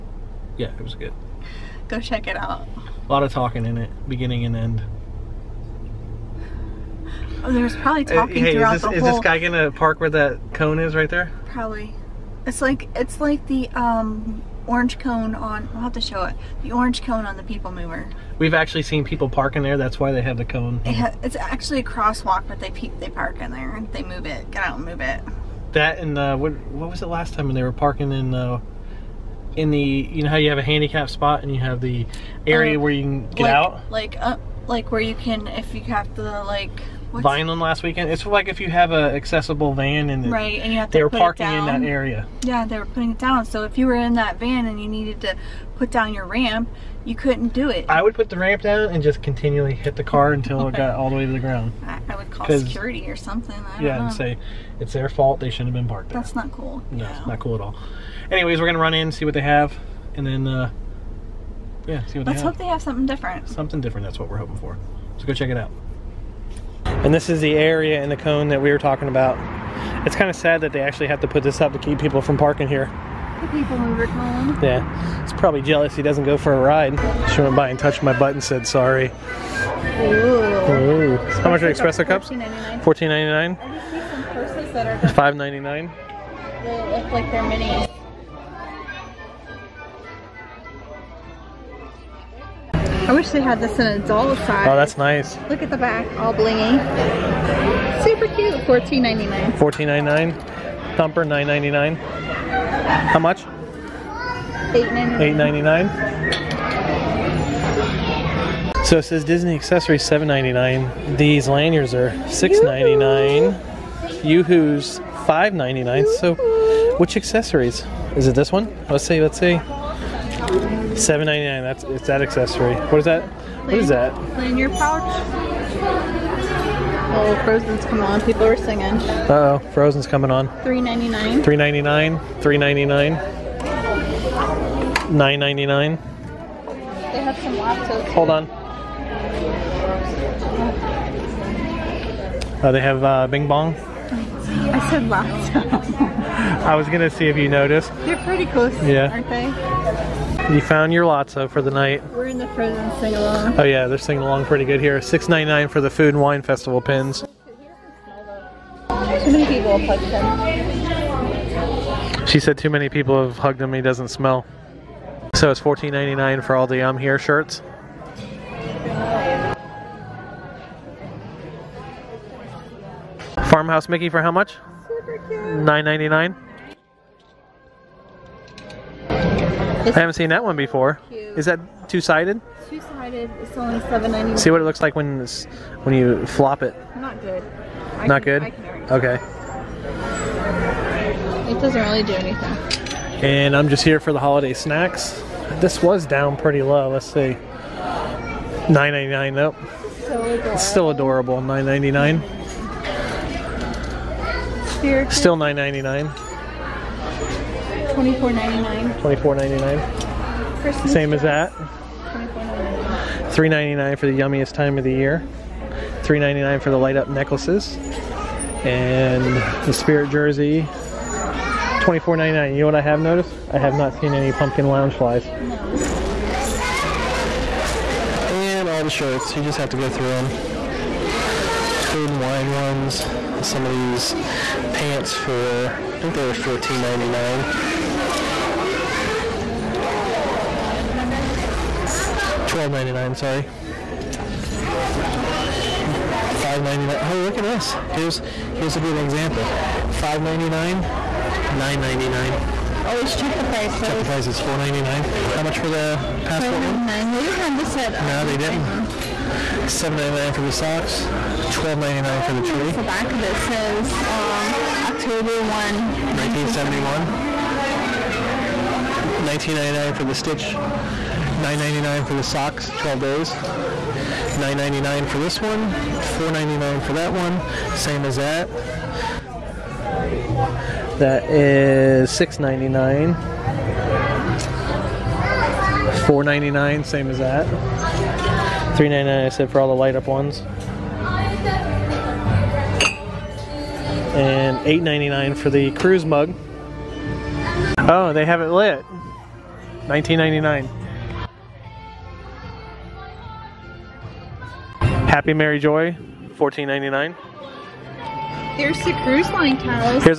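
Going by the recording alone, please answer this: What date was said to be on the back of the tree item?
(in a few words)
October 1, 1971.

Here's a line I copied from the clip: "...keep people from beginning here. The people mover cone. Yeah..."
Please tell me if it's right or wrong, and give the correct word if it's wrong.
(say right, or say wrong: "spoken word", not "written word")
wrong: "parking", not "beginning".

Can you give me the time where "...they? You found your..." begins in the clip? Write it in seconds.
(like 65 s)
149 s.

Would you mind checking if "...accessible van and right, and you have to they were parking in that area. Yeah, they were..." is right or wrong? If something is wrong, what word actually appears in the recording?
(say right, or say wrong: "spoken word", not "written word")
right.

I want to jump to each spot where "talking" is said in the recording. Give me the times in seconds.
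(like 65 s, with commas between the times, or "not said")
3 s, 8 s, 68 s.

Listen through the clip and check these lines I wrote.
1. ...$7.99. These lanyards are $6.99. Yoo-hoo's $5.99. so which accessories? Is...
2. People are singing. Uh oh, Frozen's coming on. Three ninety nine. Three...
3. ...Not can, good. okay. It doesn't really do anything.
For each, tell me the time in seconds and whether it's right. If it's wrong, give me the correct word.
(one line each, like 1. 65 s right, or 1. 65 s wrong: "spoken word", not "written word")
1. 110 s right
2. 128 s right
3. 188 s right.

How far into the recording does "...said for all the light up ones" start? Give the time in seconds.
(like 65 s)
289 s.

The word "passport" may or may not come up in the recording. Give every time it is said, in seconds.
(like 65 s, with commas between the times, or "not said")
256 s.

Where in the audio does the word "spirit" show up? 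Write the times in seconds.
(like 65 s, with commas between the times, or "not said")
219 s.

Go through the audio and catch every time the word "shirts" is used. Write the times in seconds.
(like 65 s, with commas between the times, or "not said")
167 s, 228 s.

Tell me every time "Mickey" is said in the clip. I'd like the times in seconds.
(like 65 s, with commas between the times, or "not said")
173 s.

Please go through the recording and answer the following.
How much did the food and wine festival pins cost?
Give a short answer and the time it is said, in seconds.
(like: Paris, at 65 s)
$6.99, at 155 s.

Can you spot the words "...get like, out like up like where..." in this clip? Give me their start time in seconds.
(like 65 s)
33 s.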